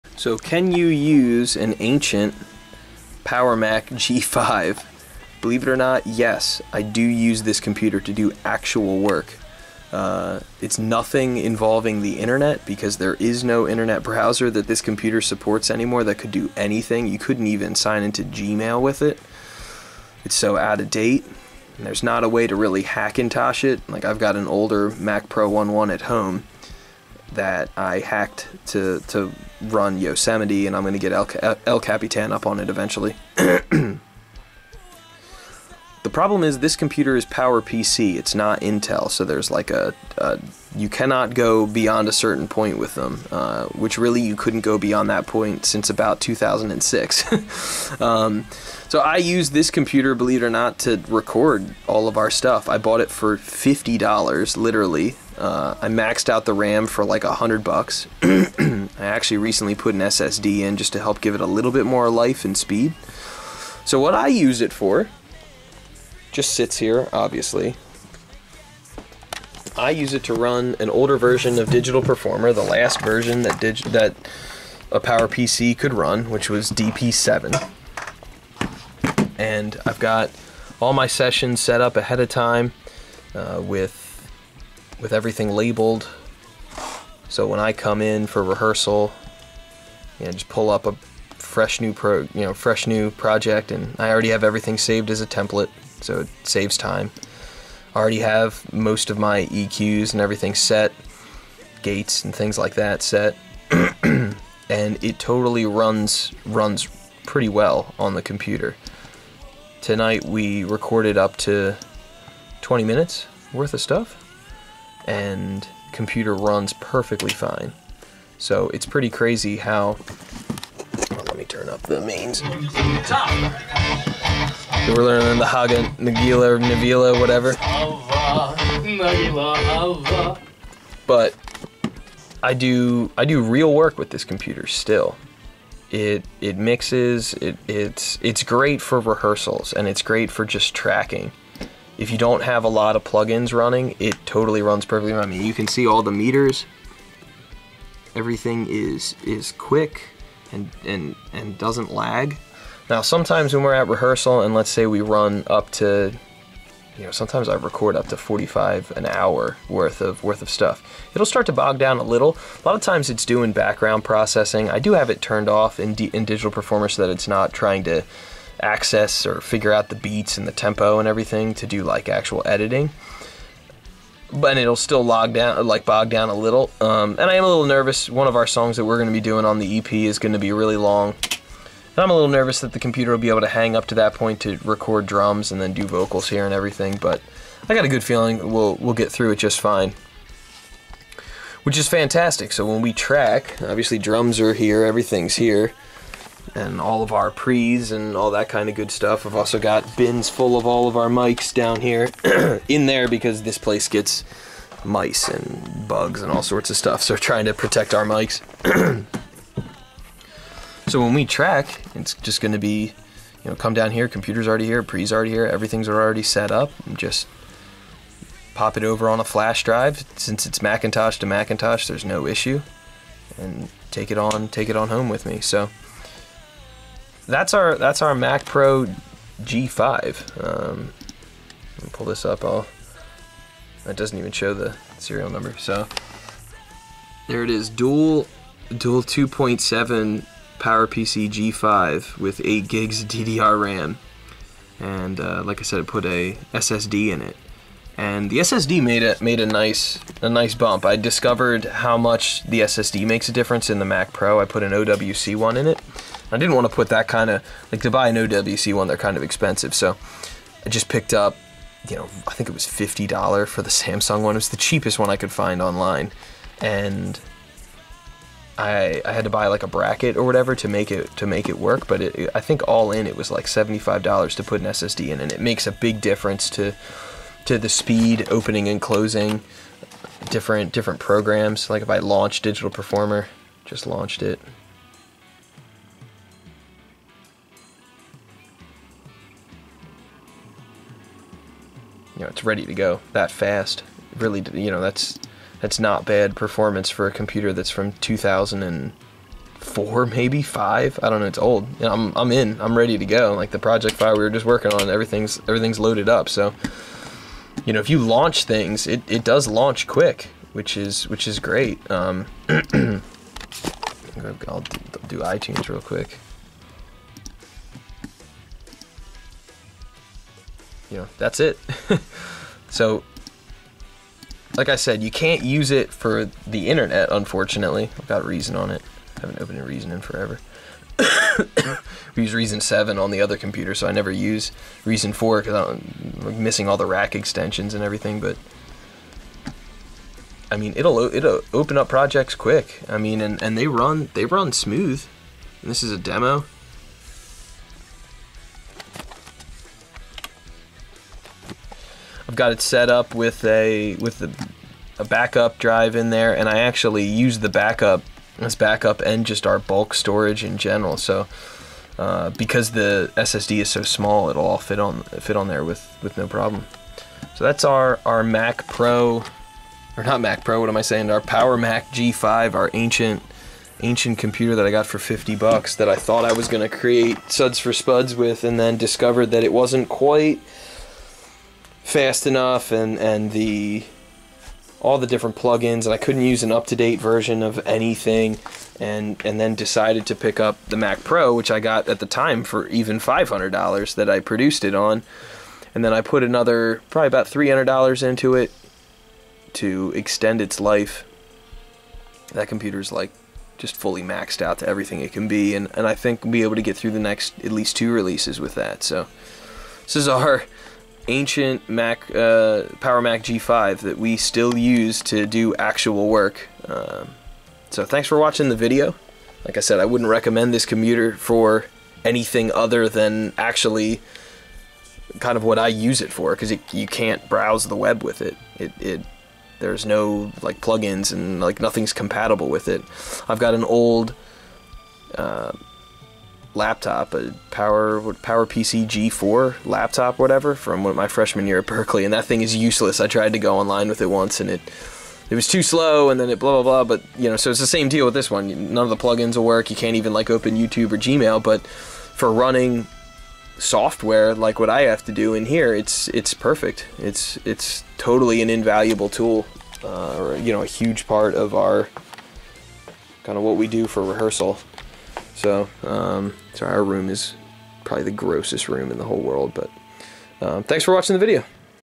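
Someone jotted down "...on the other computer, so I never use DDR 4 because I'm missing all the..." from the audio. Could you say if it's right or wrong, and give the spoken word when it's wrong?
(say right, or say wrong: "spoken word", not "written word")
wrong: "Reason", not "DDR".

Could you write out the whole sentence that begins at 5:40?
I mean, it'll it'll open up projects quick.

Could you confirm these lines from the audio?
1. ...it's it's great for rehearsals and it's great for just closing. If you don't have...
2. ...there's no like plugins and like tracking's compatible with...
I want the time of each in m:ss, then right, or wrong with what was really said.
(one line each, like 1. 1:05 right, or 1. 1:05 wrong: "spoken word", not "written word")
1. 2:17 wrong: "tracking", not "closing"
2. 7:09 wrong: "nothing", not "tracking".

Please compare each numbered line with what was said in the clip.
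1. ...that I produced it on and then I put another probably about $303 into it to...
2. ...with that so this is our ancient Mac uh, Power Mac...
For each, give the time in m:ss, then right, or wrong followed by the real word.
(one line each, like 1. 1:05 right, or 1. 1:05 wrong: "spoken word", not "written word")
1. 6:33 wrong: "300", not "303"
2. 6:48 right.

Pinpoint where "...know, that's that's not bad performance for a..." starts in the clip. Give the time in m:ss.
4:54.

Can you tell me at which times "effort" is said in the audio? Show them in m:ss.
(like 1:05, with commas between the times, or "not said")
not said.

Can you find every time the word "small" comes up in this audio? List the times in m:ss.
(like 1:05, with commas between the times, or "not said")
6:03.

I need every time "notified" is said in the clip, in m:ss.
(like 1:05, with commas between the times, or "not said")
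not said.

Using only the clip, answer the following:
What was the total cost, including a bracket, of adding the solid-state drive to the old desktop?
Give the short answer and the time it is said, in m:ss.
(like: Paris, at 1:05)
$75, at 4:33.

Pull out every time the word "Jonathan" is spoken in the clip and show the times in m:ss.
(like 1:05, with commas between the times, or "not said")
not said.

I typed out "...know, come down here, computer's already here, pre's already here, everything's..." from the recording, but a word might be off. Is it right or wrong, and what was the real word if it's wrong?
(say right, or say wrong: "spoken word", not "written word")
right.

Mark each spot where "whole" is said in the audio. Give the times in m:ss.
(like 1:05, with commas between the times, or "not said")
7:49.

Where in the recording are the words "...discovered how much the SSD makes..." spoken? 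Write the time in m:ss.
4:10.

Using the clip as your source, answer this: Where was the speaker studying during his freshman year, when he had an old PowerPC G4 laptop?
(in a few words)
Berkeley.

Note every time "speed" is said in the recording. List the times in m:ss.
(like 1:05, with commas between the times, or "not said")
1:02, 4:37.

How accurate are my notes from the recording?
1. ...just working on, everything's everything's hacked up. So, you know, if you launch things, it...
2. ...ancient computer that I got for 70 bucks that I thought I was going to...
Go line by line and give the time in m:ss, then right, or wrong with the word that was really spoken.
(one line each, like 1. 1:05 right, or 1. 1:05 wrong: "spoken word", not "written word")
1. 5:04 wrong: "loaded", not "hacked"
2. 6:13 wrong: "50", not "70".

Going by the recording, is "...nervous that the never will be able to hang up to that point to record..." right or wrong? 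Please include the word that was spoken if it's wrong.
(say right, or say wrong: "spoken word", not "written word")
wrong: "computer", not "never".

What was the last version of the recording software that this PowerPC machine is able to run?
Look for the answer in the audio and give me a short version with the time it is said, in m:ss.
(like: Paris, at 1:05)
DP7, at 1:16.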